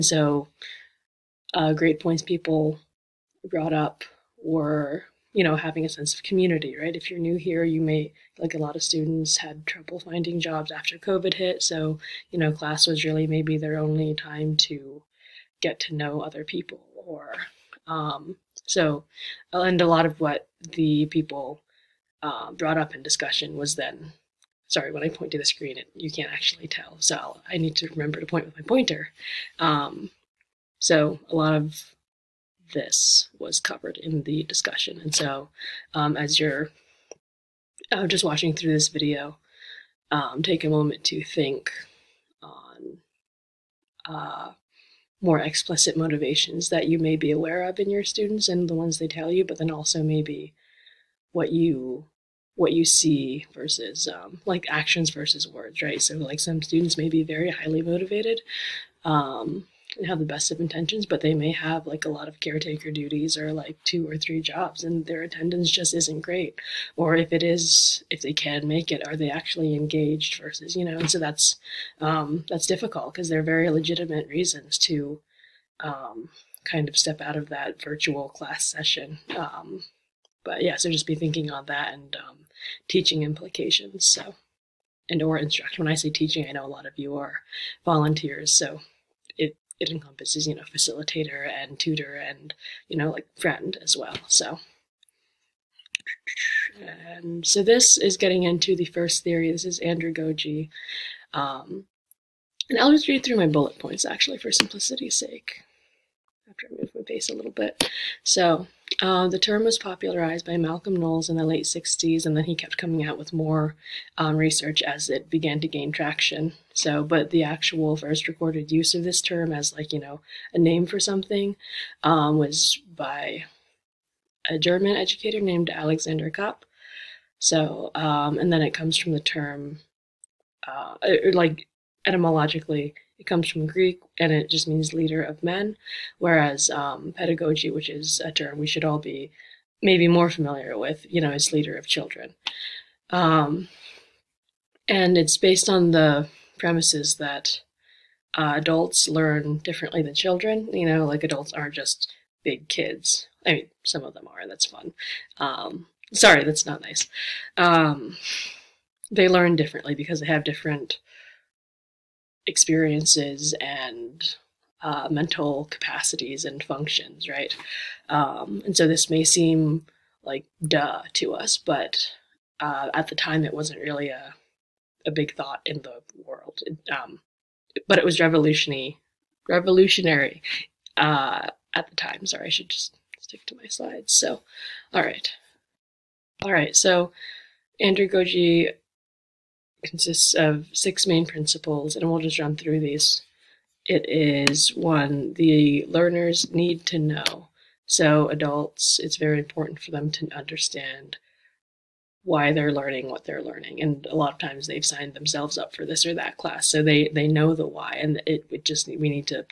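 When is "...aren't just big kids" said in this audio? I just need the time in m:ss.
2:31.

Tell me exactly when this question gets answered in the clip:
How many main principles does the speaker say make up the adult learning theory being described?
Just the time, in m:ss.
3:10.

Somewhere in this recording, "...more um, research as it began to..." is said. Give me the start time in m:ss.
1:53.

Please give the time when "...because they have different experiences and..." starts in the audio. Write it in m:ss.
2:39.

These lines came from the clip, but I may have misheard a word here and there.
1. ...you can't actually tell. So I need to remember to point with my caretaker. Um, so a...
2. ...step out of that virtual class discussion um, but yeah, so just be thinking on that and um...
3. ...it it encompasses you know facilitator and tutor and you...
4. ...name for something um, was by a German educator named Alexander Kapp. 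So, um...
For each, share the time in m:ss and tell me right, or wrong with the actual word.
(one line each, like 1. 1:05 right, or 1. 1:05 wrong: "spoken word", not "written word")
1. 0:25 wrong: "pointer", not "caretaker"
2. 1:16 wrong: "session", not "discussion"
3. 1:29 right
4. 2:00 right.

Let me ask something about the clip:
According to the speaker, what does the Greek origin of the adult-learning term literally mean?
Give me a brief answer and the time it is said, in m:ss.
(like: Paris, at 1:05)
leader of men, at 2:14.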